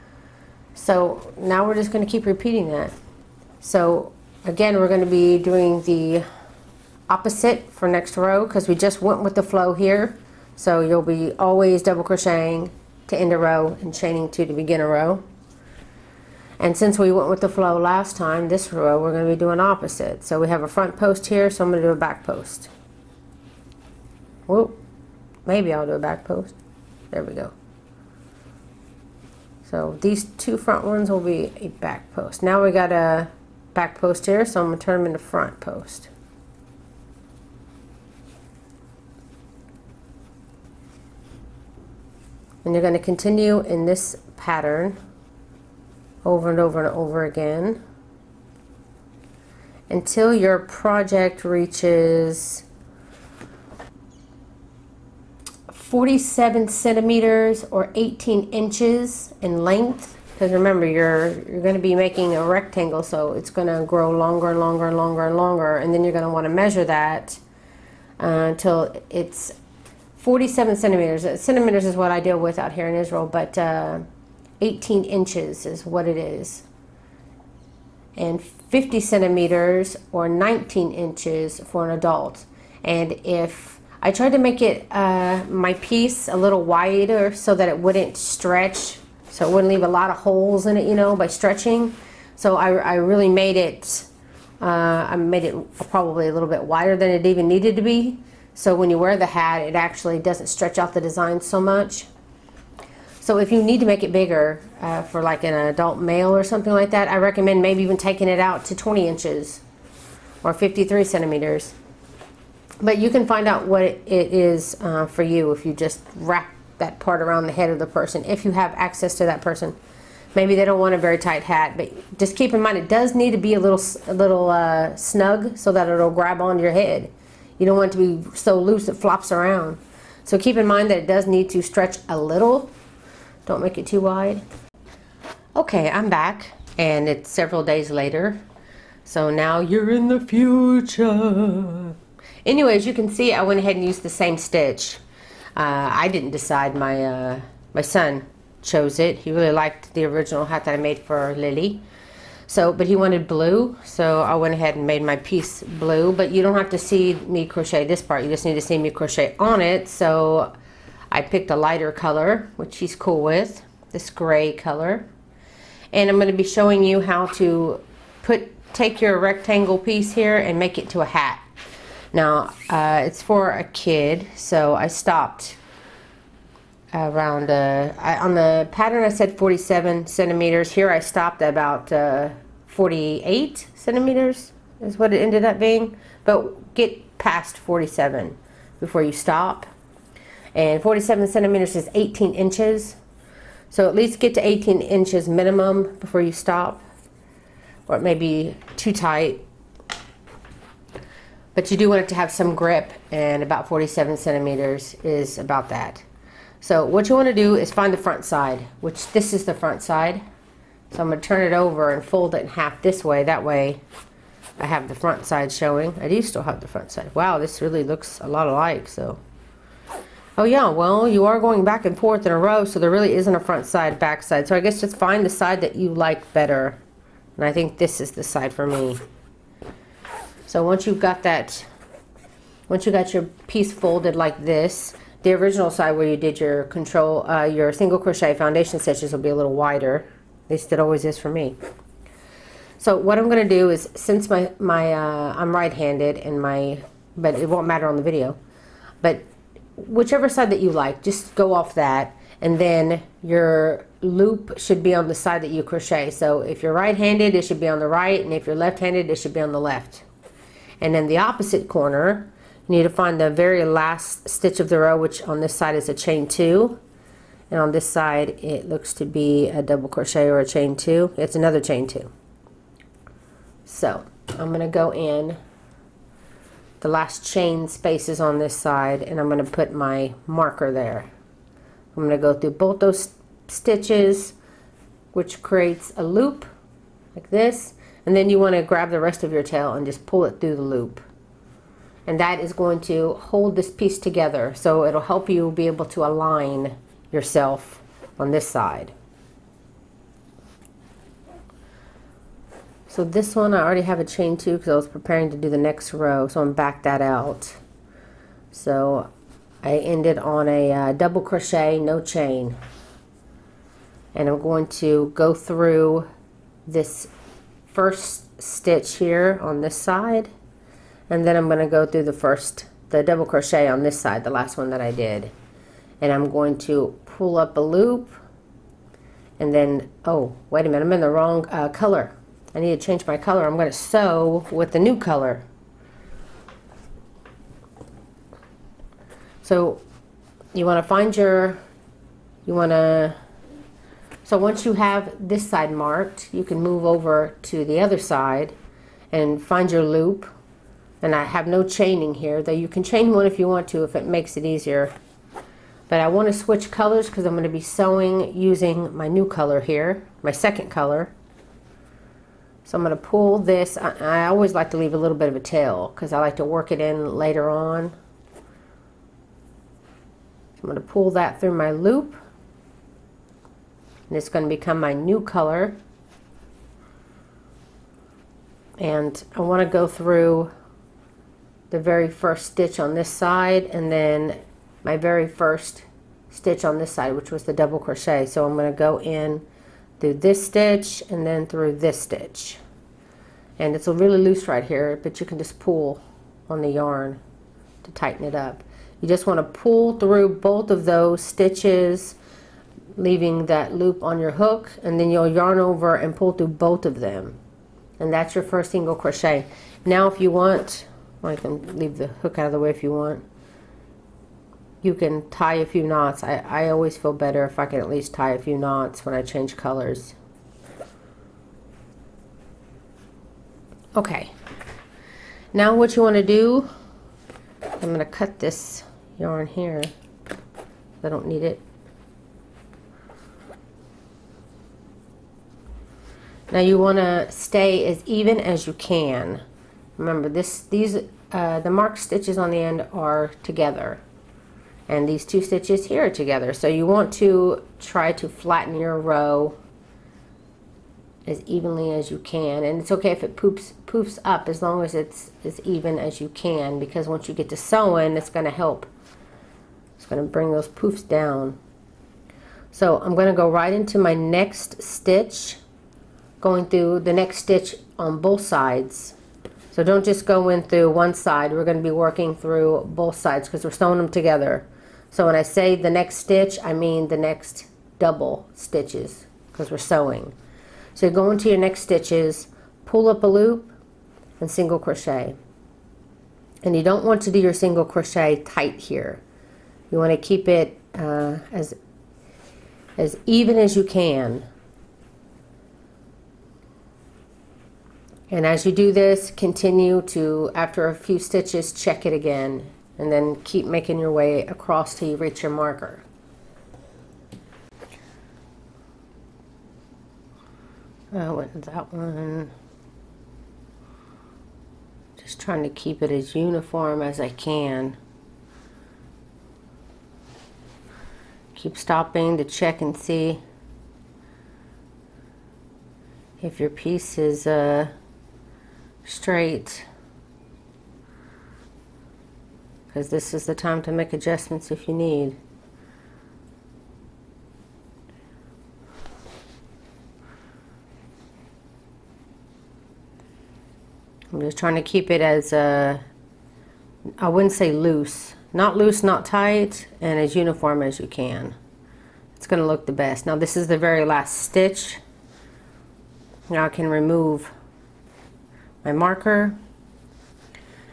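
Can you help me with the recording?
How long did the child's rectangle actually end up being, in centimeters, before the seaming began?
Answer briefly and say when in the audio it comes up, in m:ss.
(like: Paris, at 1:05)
48 centimeters, at 3:02.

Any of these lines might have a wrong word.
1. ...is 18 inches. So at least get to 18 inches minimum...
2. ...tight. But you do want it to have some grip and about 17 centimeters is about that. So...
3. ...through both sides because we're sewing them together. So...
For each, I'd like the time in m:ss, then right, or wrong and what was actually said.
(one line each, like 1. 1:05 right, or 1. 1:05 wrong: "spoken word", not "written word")
1. 3:11 right
2. 3:18 wrong: "47", not "17"
3. 7:52 right.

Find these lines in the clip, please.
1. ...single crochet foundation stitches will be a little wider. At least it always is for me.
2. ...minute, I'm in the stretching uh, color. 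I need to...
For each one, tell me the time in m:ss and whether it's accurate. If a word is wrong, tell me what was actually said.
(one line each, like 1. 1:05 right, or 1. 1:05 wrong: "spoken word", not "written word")
1. 3:57 right
2. 5:30 wrong: "wrong", not "stretching".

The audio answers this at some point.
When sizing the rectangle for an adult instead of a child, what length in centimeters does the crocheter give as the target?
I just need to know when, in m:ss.
1:18.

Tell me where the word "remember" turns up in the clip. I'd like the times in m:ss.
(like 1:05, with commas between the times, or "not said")
1:00, 7:19.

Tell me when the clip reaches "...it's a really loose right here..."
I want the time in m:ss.
6:33.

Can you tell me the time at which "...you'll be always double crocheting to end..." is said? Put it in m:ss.
0:10.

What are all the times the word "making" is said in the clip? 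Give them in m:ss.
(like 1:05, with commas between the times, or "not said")
1:01, 8:23.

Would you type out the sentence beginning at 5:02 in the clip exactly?
So this one I already have a chain two because I was preparing to do the next row.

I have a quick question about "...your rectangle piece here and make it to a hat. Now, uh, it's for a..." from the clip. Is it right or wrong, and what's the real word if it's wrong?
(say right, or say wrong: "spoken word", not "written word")
right.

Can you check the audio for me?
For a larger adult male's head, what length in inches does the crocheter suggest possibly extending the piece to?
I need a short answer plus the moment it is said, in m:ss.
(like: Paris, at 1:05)
20 inches, at 1:48.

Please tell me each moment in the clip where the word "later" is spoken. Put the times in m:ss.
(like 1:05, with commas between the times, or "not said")
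2:17, 6:07.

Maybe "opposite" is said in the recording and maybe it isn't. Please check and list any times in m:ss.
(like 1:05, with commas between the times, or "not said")
0:07, 0:19, 4:21.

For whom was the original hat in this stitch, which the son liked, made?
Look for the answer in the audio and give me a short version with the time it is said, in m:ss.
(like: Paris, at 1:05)
Lily, at 2:31.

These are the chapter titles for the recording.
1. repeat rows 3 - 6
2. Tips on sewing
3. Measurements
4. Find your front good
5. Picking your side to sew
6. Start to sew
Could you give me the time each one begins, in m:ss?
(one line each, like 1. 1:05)
1. 0:42
2. 2:15
3. 2:55
4. 3:21
5. 4:02
6. 6:01.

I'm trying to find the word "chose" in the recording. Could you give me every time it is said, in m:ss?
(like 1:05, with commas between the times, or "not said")
2:28.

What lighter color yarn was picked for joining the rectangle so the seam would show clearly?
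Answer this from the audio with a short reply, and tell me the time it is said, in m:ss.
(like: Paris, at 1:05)
Gray, at 2:44.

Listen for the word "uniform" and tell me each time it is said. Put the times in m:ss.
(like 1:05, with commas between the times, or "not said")
8:36, 9:10.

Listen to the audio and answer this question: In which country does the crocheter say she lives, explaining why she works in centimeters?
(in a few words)
Israel.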